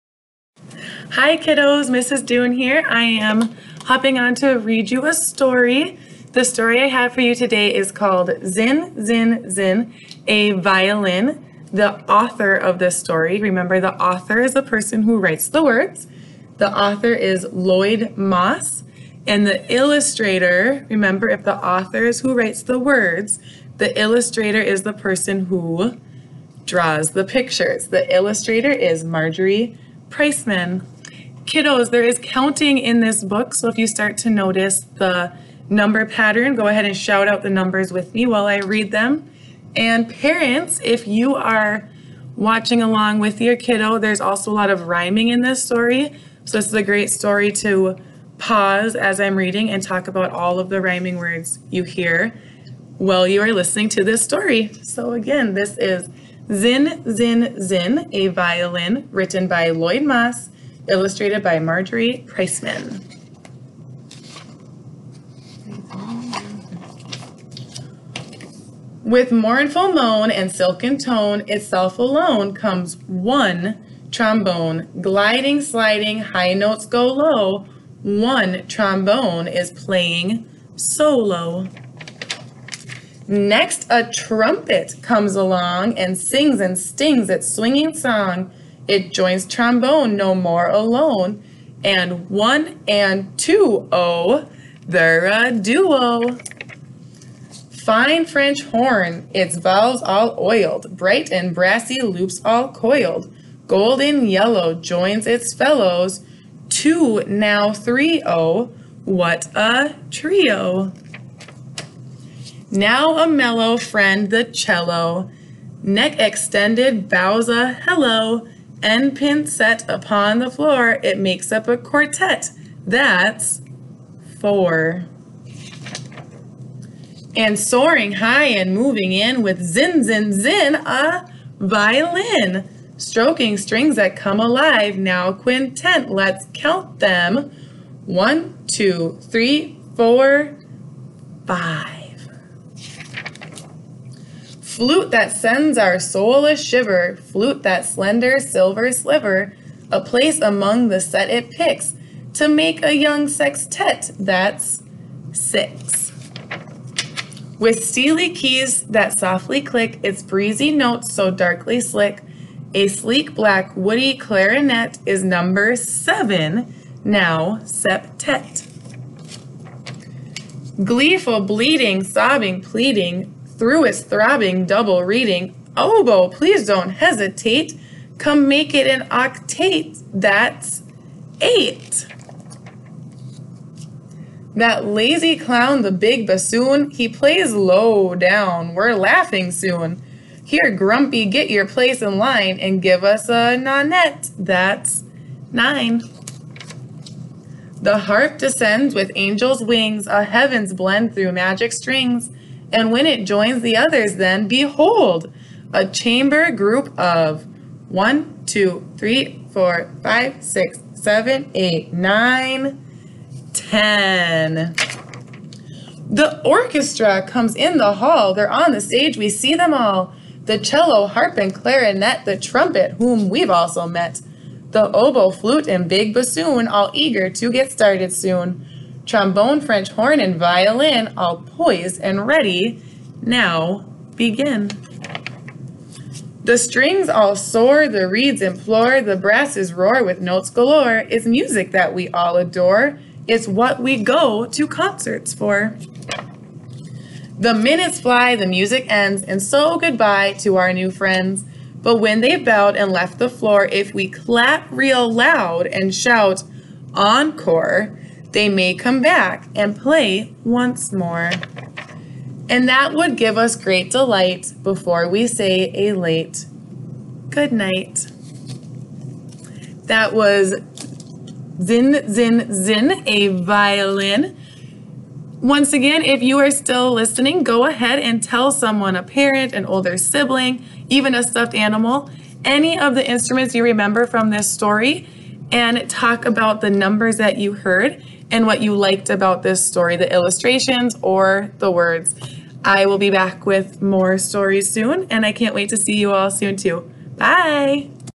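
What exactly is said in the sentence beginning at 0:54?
So again, this is Zin, Zin, Zin, a violin written by Lloyd Moss illustrated by Marjorie Priceman.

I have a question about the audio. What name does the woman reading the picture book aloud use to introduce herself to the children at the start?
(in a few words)
Mrs. Doon.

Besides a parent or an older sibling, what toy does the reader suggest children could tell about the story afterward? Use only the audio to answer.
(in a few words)
a stuffed animal.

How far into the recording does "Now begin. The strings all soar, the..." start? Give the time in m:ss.
3:53.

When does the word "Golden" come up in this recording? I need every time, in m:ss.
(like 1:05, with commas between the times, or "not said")
1:43.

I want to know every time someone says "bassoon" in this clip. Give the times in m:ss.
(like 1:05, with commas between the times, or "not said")
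3:06, 3:46.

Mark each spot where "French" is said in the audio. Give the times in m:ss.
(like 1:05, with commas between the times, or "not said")
1:38, 3:49.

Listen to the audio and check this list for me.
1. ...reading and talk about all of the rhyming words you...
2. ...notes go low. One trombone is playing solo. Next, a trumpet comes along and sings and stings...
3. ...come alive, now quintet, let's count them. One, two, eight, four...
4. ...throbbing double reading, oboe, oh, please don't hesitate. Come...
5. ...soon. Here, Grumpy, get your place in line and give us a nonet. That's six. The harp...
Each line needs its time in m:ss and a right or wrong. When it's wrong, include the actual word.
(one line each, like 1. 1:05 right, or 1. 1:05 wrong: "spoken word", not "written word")
1. 0:49 right
2. 1:16 right
3. 2:14 wrong: "three", not "eight"
4. 2:54 right
5. 3:09 wrong: "nine", not "six".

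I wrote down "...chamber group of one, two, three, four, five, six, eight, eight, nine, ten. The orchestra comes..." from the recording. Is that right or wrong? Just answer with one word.
wrong.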